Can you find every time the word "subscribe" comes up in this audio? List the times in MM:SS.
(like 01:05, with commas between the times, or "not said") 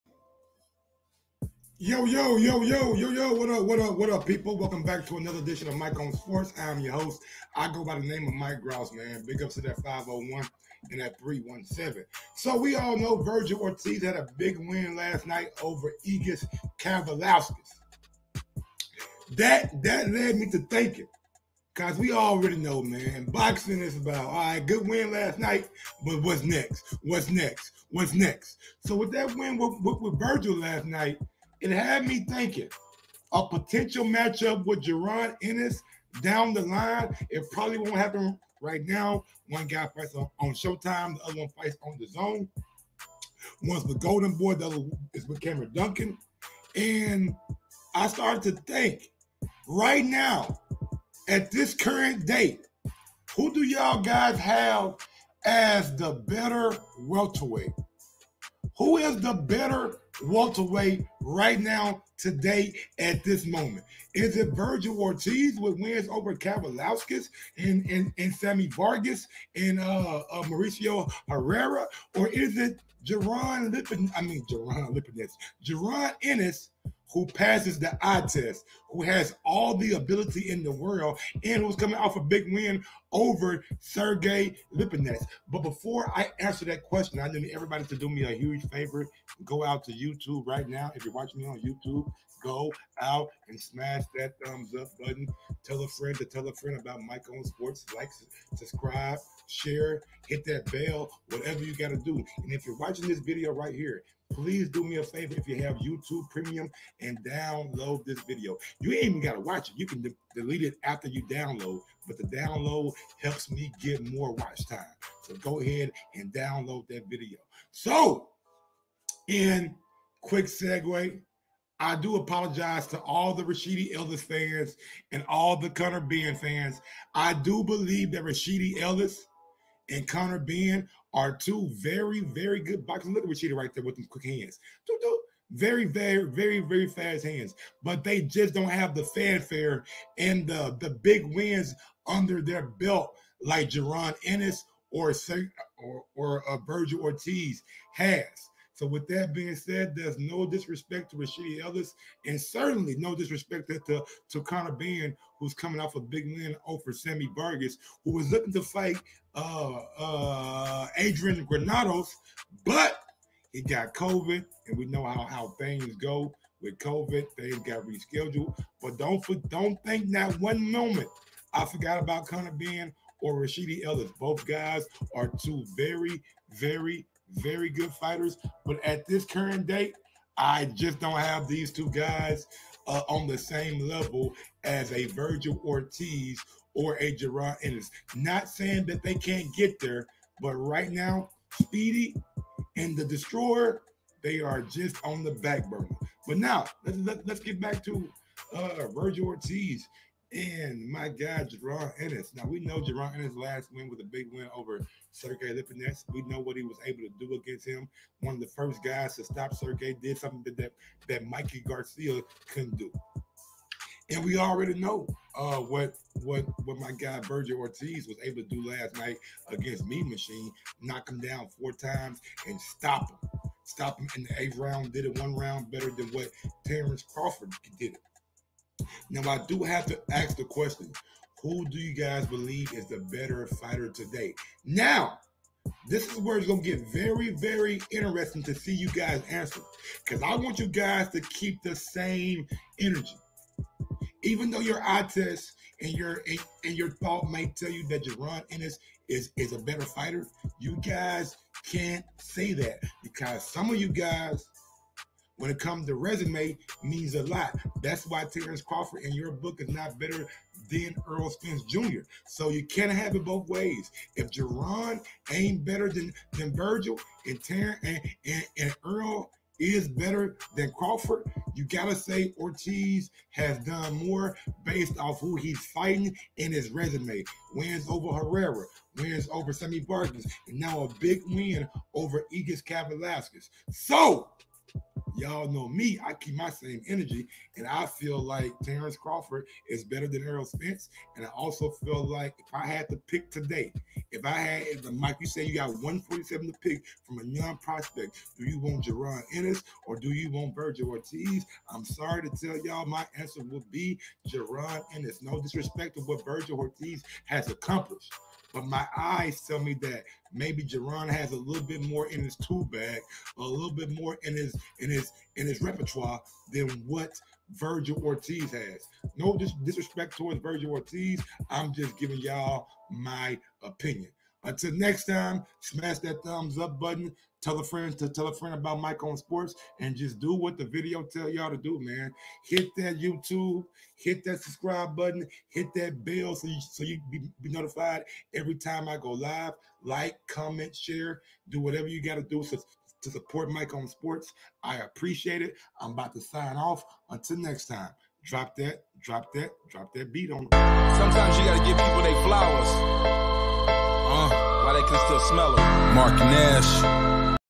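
01:38, 05:34.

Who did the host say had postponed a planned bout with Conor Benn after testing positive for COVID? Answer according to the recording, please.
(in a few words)
Adrian Granados.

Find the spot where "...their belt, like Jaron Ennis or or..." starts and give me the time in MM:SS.
02:22.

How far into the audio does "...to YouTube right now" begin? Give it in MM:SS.
01:29.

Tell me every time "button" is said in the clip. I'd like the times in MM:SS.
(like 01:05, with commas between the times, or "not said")
01:34, 05:26, 05:34.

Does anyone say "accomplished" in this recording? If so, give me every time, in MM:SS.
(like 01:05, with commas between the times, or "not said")
05:07.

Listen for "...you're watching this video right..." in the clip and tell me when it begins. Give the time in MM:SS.
01:42.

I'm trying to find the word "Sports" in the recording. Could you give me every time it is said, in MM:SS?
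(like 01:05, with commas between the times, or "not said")
00:06, 01:37, 05:29, 05:43.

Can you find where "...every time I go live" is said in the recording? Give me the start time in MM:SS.
05:38.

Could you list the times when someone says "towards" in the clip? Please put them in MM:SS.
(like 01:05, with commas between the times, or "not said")
05:20.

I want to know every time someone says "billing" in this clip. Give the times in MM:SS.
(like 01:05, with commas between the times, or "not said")
not said.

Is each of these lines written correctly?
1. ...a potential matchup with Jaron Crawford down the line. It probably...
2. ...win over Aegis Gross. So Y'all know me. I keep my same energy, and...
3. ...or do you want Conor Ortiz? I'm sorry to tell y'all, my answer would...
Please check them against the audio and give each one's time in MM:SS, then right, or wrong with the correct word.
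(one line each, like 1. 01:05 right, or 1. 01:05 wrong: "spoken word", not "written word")
1. 00:33 wrong: "Ennis", not "Crawford"
2. 04:41 wrong: "Kavaliauskas", not "Gross"
3. 04:59 wrong: "Vergil", not "Conor".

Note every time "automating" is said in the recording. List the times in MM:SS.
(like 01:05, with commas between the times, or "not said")
not said.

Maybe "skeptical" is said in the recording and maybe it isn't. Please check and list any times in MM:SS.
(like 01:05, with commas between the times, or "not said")
not said.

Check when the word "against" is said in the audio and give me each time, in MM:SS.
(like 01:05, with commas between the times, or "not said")
03:27, 03:39.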